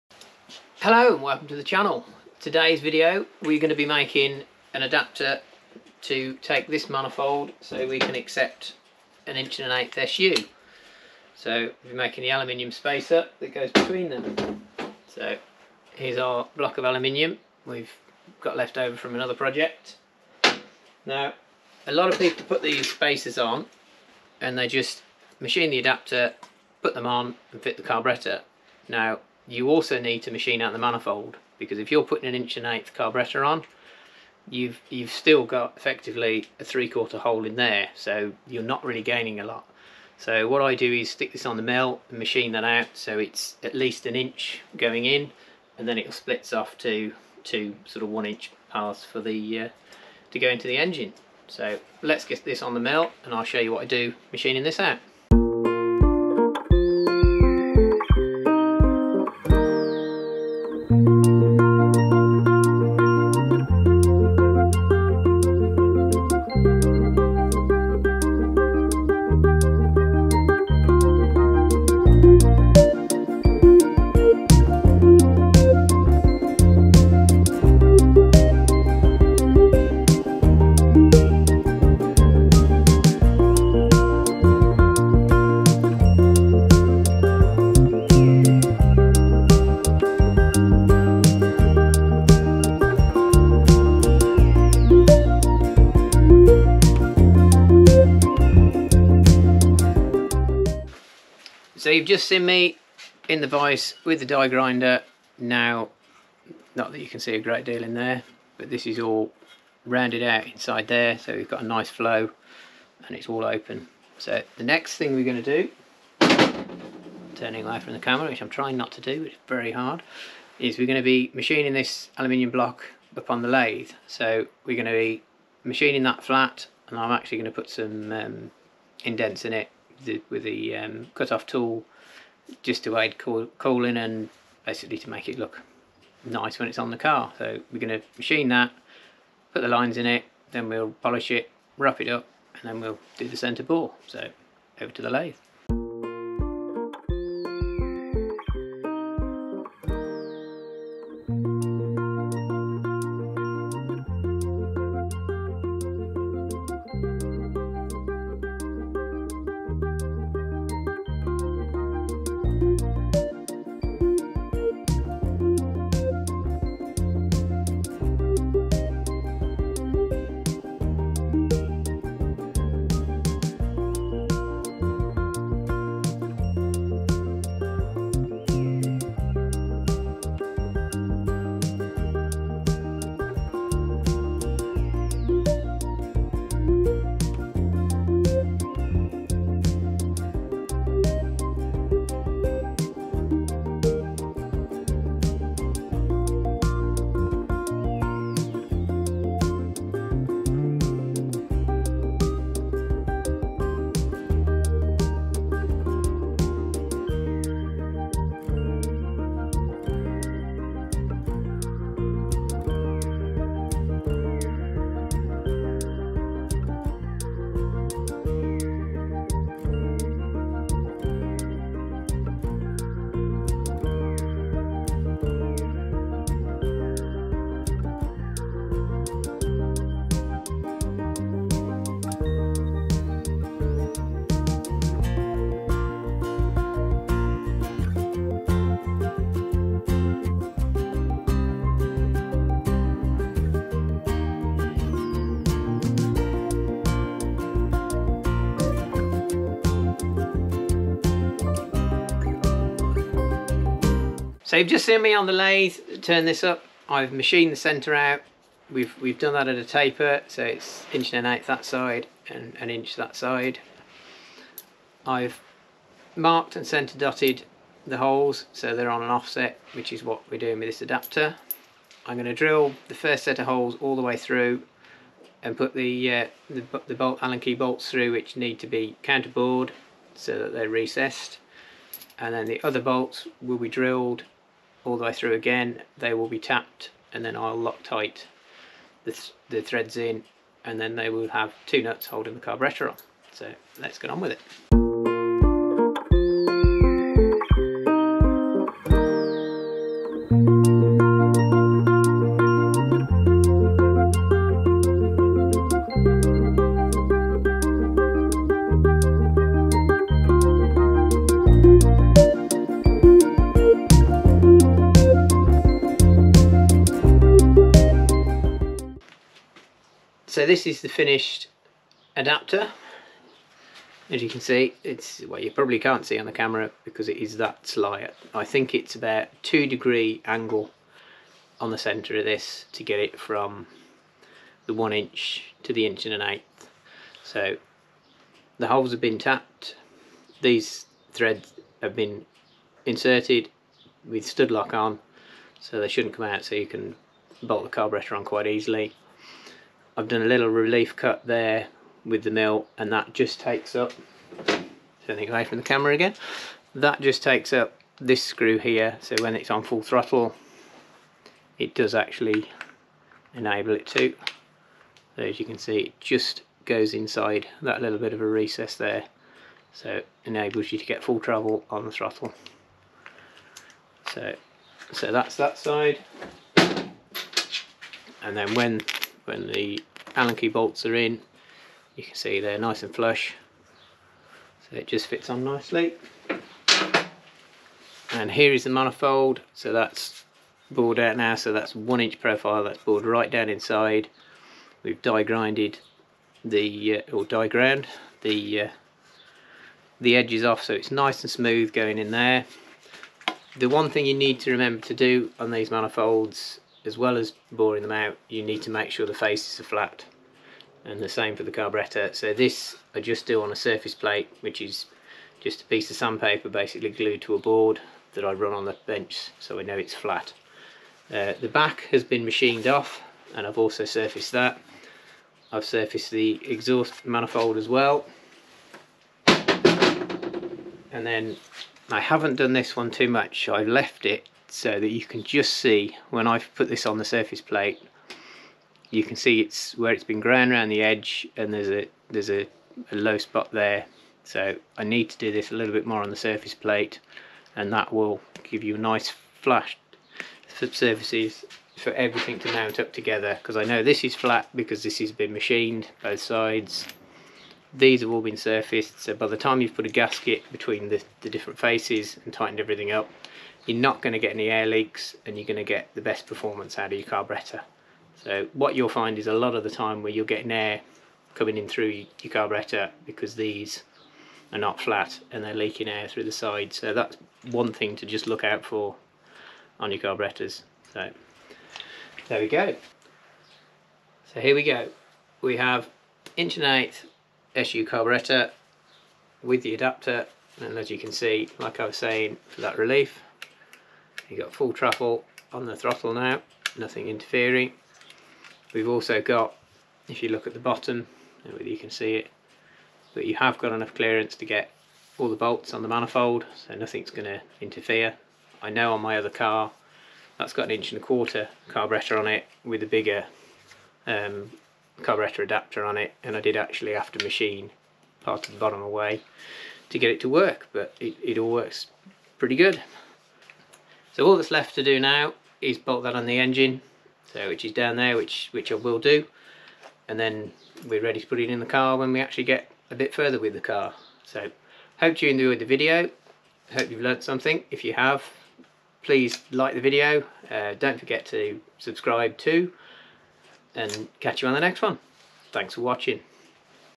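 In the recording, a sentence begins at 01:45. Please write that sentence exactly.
Now, not that you can see a great deal in there, but this is all rounded out inside there.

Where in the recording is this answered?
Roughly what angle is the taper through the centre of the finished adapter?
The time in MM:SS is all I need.
05:29.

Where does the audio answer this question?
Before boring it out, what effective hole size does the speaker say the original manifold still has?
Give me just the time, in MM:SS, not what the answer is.
00:36.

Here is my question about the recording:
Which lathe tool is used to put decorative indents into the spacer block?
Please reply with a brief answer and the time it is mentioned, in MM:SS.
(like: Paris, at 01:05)
Cut-off tool, at 02:11.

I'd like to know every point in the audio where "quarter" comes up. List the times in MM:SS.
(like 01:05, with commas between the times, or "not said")
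00:36, 08:31.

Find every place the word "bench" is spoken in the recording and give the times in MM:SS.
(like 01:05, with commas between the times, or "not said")
06:58.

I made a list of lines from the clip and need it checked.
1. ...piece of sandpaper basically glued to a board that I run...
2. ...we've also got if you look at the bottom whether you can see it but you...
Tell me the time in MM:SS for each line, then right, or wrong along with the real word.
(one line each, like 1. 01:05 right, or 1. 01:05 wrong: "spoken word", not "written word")
1. 06:55 right
2. 08:18 right.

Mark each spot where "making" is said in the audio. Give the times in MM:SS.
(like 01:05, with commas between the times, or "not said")
00:03, 00:11.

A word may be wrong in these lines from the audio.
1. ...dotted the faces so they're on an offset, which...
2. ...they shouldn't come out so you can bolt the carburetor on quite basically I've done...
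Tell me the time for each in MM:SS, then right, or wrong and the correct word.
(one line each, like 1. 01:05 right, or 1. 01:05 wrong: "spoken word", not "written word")
1. 04:26 wrong: "holes", not "faces"
2. 05:45 wrong: "easily", not "basically".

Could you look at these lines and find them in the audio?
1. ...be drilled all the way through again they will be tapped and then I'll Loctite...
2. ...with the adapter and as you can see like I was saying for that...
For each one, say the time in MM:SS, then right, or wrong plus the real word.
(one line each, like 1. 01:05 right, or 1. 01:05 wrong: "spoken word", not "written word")
1. 04:43 right
2. 08:09 right.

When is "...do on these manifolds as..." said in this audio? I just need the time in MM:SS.
06:44.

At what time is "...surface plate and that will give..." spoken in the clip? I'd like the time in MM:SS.
07:26.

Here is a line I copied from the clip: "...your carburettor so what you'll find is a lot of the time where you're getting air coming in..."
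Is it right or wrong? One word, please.
right.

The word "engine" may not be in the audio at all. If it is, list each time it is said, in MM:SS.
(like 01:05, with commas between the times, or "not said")
00:50, 08:46.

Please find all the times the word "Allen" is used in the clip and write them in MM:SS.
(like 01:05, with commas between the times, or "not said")
04:37, 06:20.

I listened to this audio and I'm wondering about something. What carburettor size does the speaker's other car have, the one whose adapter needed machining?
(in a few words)
1 1/4 inch.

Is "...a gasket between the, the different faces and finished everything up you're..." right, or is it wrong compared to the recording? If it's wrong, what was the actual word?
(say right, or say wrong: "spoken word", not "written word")
wrong: "tightened", not "finished".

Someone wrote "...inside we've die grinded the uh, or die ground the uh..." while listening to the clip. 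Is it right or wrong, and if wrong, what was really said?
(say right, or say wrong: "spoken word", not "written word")
right.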